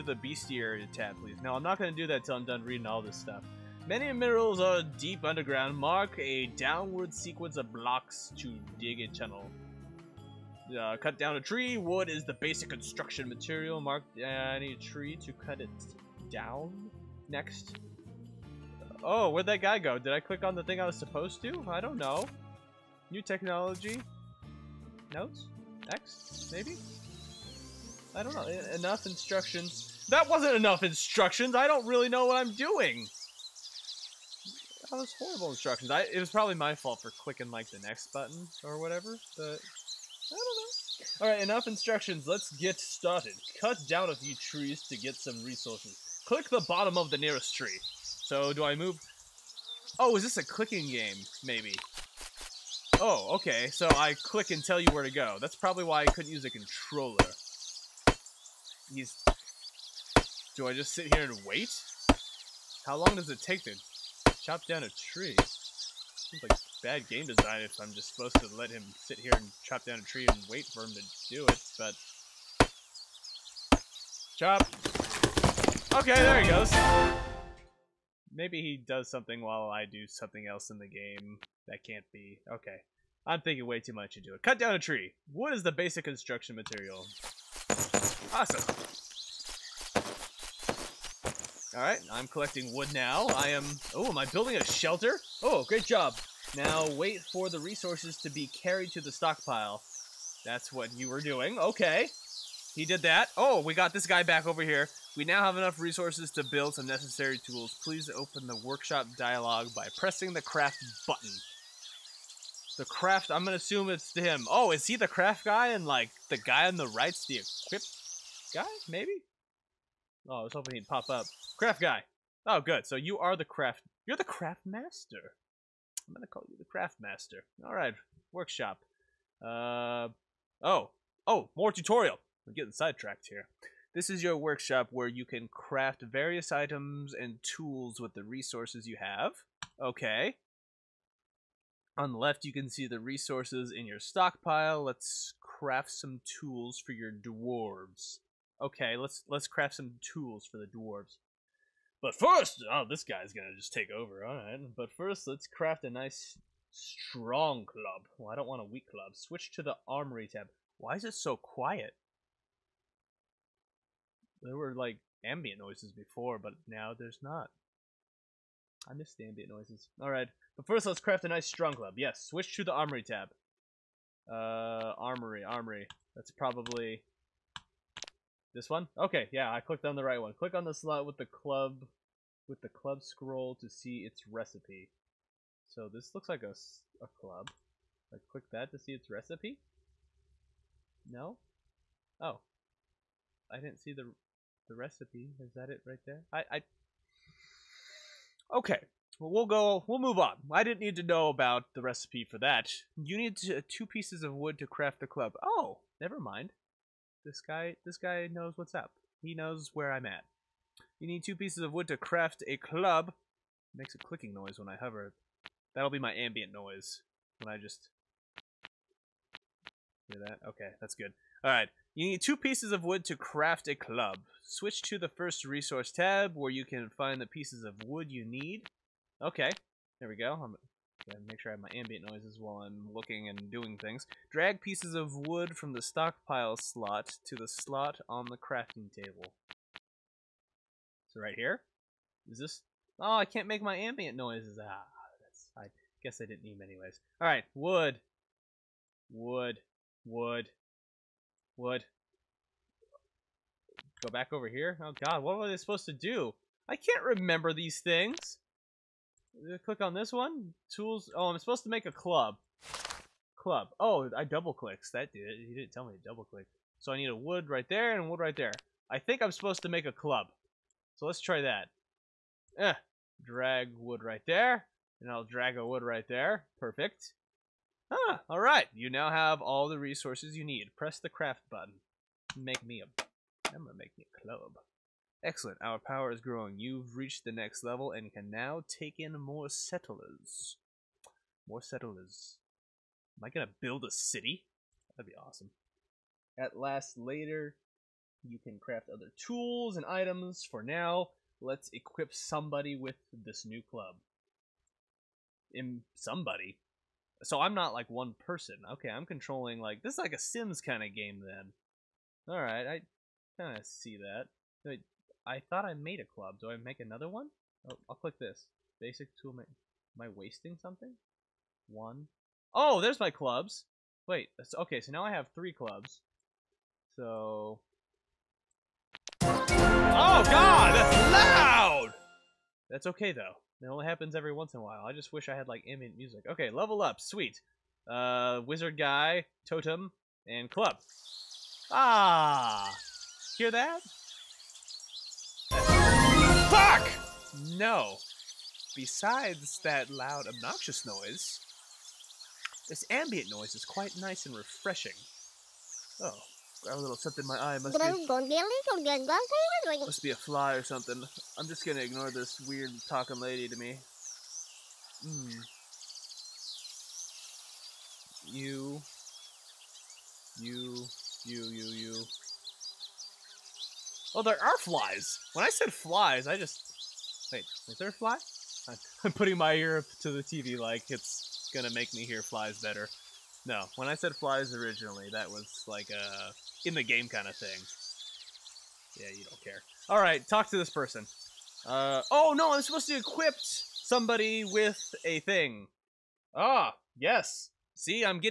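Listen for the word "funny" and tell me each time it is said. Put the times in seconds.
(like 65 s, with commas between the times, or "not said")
not said.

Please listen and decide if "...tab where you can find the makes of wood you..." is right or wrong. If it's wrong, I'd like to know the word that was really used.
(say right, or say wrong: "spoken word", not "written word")
wrong: "pieces", not "makes".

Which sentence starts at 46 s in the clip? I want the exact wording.
Click the bottom of the nearest tree.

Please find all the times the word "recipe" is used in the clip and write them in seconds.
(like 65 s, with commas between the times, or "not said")
184 s, 189 s, 194 s, 201 s.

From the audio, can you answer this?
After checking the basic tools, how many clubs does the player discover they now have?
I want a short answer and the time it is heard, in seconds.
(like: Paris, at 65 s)
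3, at 325 s.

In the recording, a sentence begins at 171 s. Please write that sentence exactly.
Yes, switch to the armory tab.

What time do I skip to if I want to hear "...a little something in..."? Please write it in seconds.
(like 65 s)
356 s.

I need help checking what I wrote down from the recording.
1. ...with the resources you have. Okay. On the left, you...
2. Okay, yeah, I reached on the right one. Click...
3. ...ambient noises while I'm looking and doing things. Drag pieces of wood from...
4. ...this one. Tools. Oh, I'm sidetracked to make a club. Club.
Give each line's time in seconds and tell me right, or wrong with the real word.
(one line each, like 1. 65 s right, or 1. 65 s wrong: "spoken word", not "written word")
1. 137 s right
2. 178 s wrong: "clicked", not "reached"
3. 231 s right
4. 259 s wrong: "supposed", not "sidetracked".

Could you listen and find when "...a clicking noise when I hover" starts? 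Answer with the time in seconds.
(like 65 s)
213 s.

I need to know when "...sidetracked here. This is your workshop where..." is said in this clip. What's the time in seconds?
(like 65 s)
132 s.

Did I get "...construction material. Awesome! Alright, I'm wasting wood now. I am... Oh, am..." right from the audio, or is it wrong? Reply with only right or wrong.
wrong.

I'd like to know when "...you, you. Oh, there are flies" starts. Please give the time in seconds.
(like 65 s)
371 s.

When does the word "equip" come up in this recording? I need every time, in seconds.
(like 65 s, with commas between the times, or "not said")
117 s, 301 s, 392 s.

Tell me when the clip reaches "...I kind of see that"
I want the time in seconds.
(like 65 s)
312 s.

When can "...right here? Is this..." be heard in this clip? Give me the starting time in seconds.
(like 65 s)
241 s.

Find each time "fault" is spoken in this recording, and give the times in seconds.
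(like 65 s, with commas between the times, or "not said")
36 s.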